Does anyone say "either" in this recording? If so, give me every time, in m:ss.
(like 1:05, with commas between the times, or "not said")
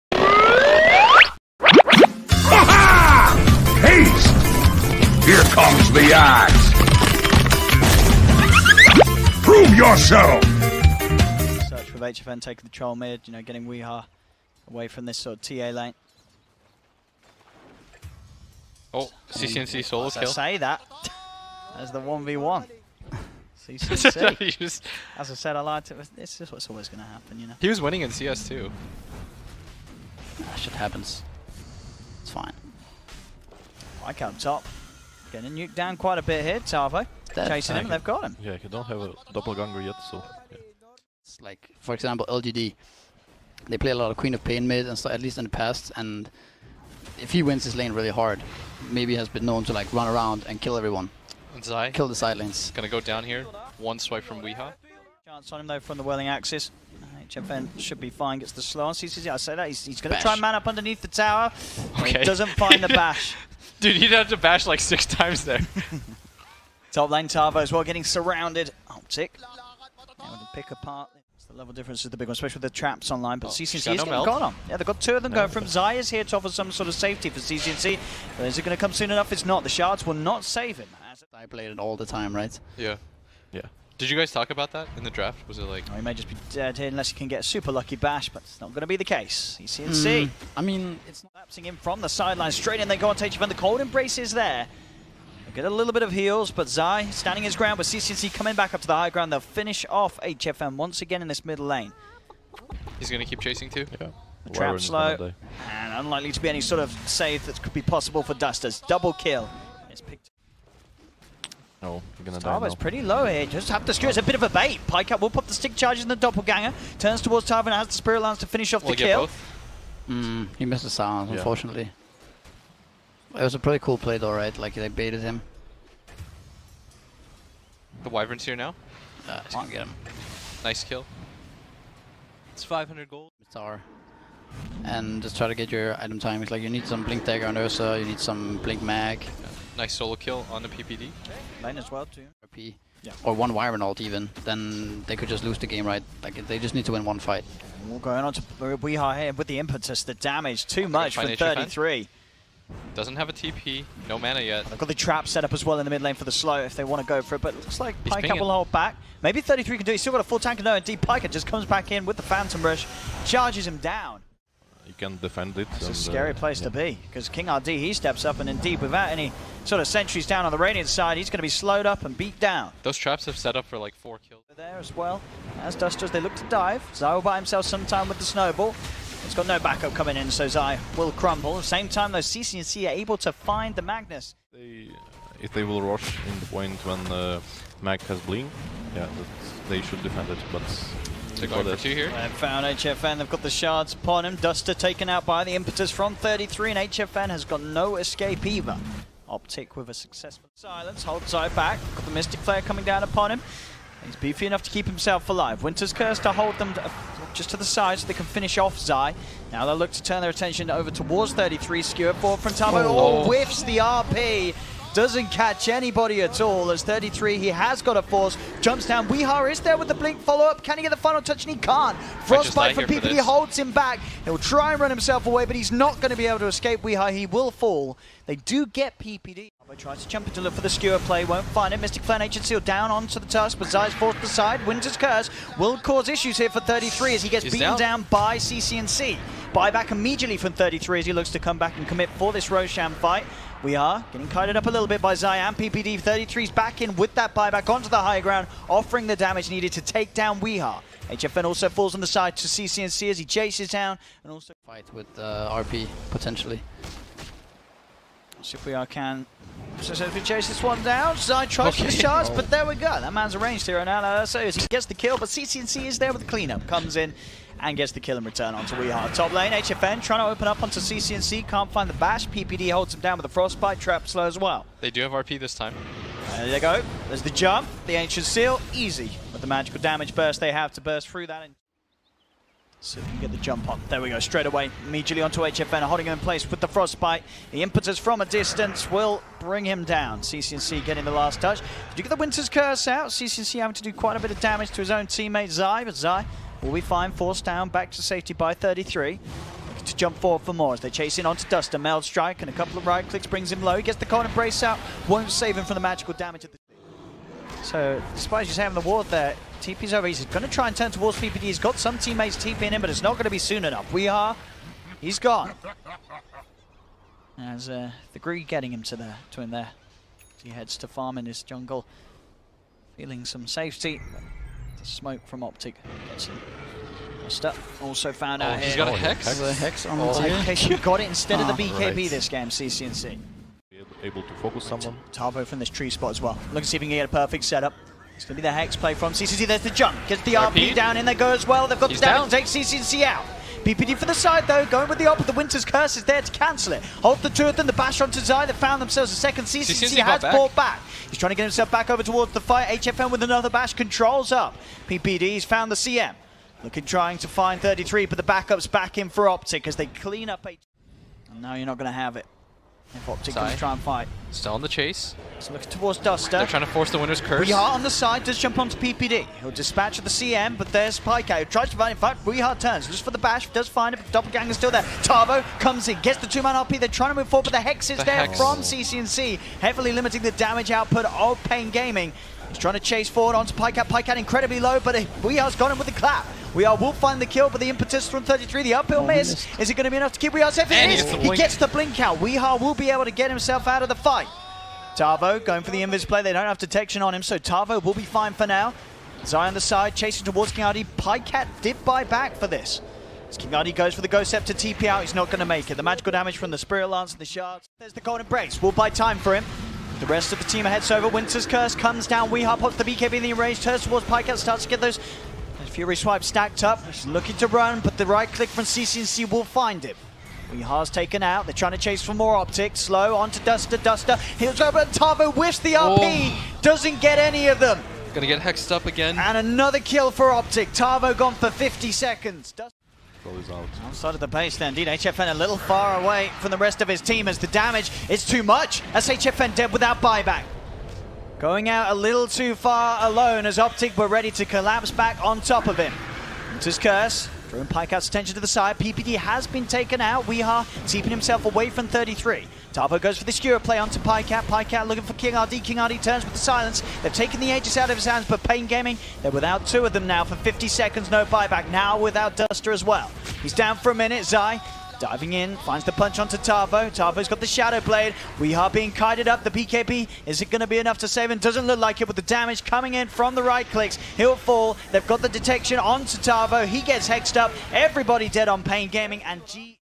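3:18.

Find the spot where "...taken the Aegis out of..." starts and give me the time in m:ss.
7:37.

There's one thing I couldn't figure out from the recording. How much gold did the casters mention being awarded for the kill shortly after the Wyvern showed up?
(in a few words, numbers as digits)
500 gold.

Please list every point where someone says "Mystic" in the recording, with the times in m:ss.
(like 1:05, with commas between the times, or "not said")
3:22, 3:51.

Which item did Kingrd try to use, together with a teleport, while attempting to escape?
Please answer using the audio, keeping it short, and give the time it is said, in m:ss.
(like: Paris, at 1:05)
Ghost Scepter, at 6:44.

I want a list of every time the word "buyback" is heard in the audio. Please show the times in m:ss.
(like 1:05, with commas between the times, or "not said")
3:59, 4:07, 7:20, 7:41.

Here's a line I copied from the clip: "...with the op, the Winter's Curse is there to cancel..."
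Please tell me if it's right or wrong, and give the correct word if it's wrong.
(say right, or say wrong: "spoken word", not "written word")
right.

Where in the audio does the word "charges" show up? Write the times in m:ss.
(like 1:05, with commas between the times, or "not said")
1:55, 2:43, 4:21.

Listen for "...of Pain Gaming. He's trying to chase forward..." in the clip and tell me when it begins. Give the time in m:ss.
6:21.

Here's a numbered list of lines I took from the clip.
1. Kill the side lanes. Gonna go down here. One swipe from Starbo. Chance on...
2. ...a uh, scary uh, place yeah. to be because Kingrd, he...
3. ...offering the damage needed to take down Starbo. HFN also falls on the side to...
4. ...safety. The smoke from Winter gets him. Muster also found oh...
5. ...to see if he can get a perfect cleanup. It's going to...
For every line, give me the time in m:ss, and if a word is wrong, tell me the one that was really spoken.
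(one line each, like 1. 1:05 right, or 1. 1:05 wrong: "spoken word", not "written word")
1. 0:51 wrong: "Weeha", not "Starbo"
2. 2:45 right
3. 4:08 wrong: "Weehar", not "Starbo"
4. 5:23 wrong: "Optic", not "Winter"
5. 5:36 wrong: "setup", not "cleanup".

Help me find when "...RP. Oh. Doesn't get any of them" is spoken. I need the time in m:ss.
7:05.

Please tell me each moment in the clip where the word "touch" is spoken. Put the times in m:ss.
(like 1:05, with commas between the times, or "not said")
3:41, 4:51.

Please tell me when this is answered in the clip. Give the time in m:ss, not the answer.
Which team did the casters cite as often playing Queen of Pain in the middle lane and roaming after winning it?
0:42.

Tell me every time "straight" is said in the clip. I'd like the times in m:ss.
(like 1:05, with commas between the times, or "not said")
1:32, 4:44.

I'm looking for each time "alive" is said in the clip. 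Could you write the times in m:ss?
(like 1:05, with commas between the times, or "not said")
3:25.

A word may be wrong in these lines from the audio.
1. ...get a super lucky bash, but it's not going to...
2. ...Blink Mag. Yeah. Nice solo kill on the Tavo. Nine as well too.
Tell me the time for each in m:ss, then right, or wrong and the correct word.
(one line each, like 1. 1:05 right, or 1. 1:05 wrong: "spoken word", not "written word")
1. 1:27 right
2. 2:18 wrong: "PPD", not "Tavo".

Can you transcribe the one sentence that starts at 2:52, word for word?
Those traps have set up for like four kills.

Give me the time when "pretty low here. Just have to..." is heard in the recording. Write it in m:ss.
1:52.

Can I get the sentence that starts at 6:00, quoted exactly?
H no, you're not going to have it.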